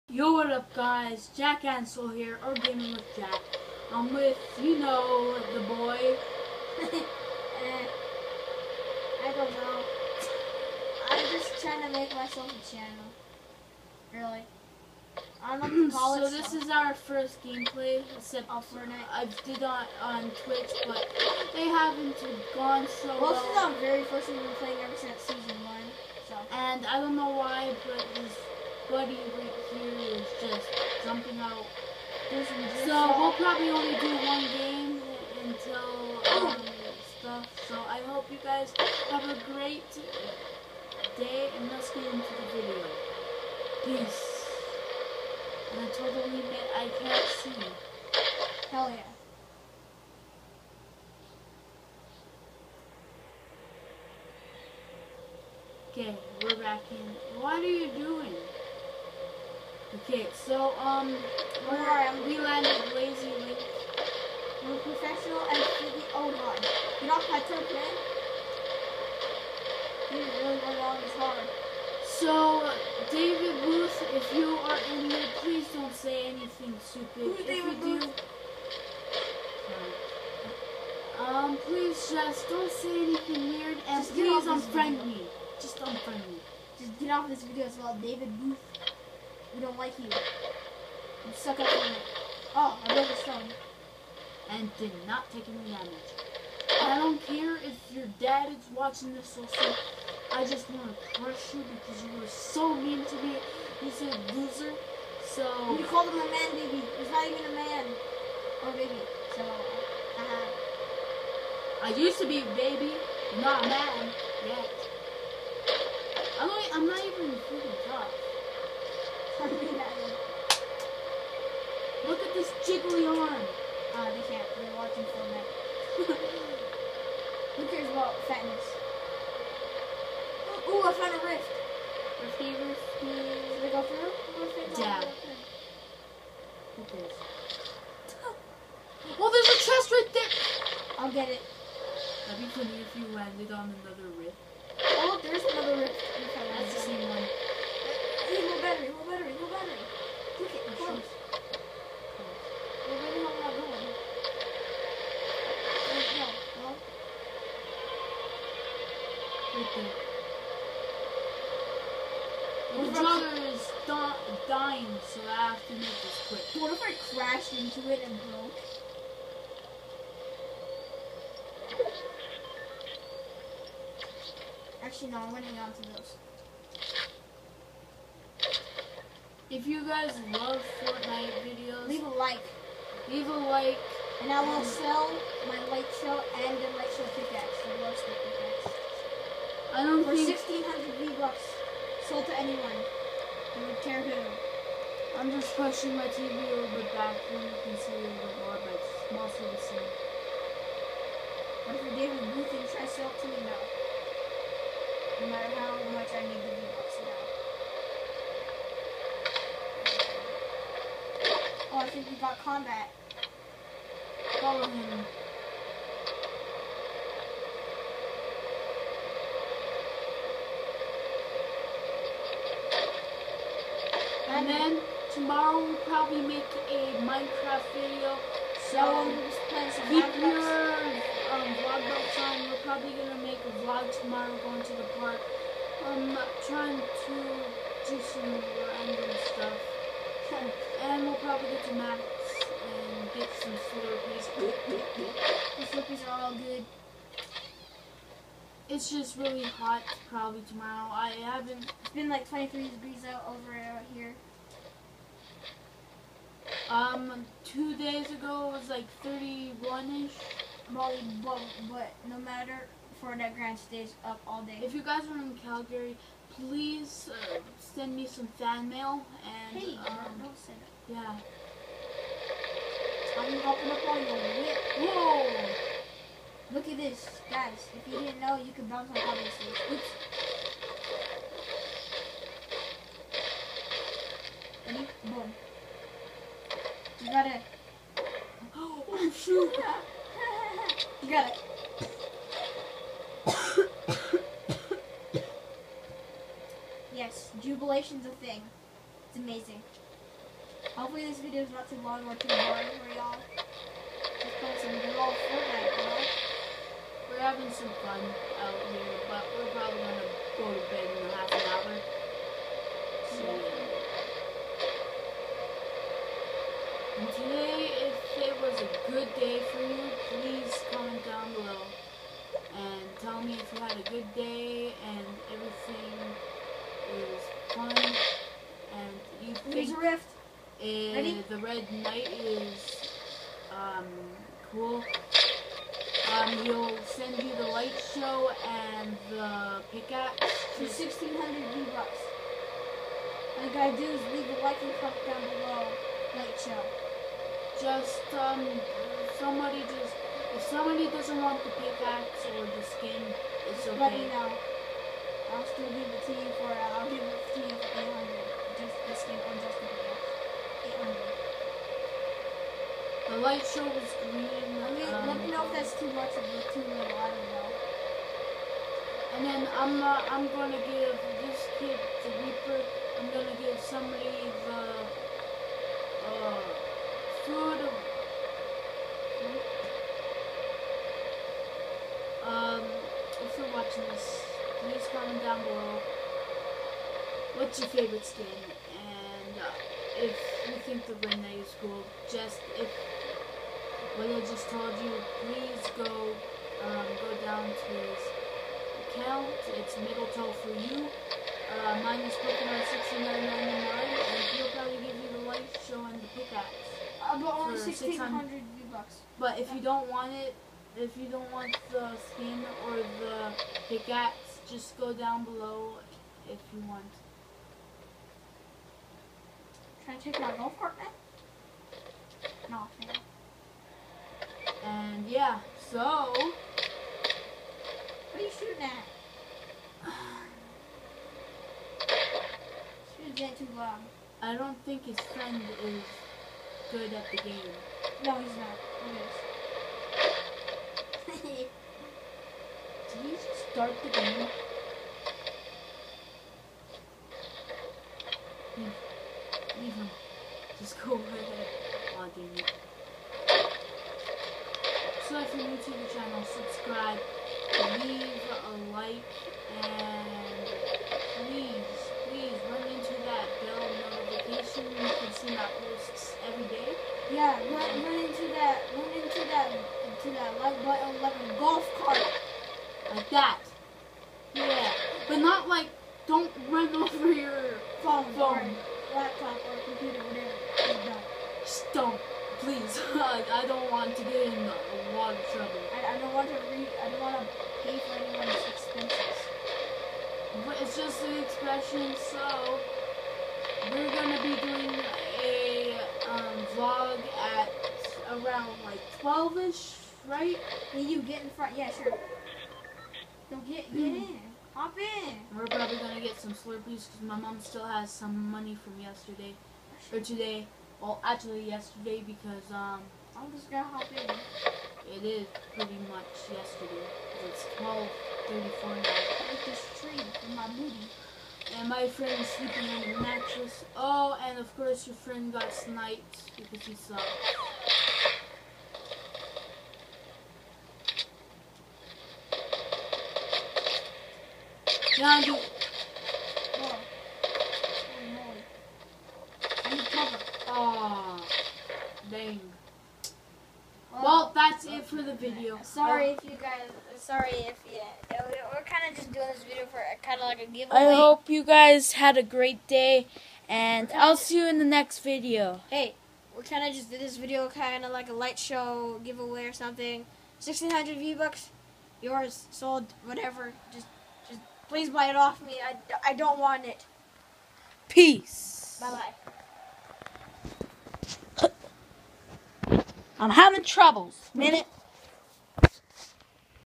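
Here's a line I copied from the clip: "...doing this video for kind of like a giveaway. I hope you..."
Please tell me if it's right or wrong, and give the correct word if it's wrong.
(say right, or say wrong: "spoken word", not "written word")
right.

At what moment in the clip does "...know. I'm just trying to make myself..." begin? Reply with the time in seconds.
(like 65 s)
9 s.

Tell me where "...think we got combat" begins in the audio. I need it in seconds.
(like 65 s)
211 s.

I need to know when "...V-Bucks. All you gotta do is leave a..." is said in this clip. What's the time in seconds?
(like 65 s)
341 s.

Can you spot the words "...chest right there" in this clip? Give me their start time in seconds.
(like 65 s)
139 s.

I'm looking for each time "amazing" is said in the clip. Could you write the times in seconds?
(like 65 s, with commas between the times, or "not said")
299 s.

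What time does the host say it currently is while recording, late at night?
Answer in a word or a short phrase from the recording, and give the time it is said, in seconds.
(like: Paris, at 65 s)
12:34, at 517 s.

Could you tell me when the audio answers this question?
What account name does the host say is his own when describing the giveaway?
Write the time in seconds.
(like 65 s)
402 s.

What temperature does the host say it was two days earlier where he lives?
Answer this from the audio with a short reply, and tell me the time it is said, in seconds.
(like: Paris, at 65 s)
31, at 259 s.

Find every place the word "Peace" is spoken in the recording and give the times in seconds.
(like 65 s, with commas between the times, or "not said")
43 s, 567 s.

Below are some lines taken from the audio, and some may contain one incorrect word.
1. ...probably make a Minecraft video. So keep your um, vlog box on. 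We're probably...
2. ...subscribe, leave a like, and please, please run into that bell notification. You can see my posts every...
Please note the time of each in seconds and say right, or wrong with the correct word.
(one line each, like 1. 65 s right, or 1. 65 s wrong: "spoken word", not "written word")
1. 225 s right
2. 456 s right.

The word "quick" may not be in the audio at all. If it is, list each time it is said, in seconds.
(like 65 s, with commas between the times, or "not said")
166 s.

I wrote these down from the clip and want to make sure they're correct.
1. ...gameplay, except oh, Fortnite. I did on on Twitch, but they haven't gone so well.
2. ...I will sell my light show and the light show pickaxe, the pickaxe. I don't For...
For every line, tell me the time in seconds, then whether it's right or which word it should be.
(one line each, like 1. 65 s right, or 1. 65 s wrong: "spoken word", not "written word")
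1. 17 s right
2. 184 s right.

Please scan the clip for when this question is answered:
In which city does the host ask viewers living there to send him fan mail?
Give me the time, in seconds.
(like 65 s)
265 s.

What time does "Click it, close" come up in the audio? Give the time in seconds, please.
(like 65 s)
150 s.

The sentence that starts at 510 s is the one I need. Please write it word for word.
Well, actually yesterday because um, I'm just gonna hop in.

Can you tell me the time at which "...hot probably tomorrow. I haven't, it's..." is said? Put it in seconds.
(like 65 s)
249 s.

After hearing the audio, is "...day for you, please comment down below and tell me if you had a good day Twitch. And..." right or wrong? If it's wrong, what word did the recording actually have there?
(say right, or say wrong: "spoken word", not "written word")
wrong: "Rift", not "Twitch".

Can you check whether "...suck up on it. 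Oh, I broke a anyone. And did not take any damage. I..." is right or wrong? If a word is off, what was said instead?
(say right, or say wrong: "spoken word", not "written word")
wrong: "stone", not "anyone".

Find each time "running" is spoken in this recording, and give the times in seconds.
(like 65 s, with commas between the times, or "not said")
175 s.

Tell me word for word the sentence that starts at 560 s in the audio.
Sixteen hundred V bucks, yours sold.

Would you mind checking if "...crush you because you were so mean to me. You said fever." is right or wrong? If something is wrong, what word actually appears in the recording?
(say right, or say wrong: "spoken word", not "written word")
wrong: "loser", not "fever".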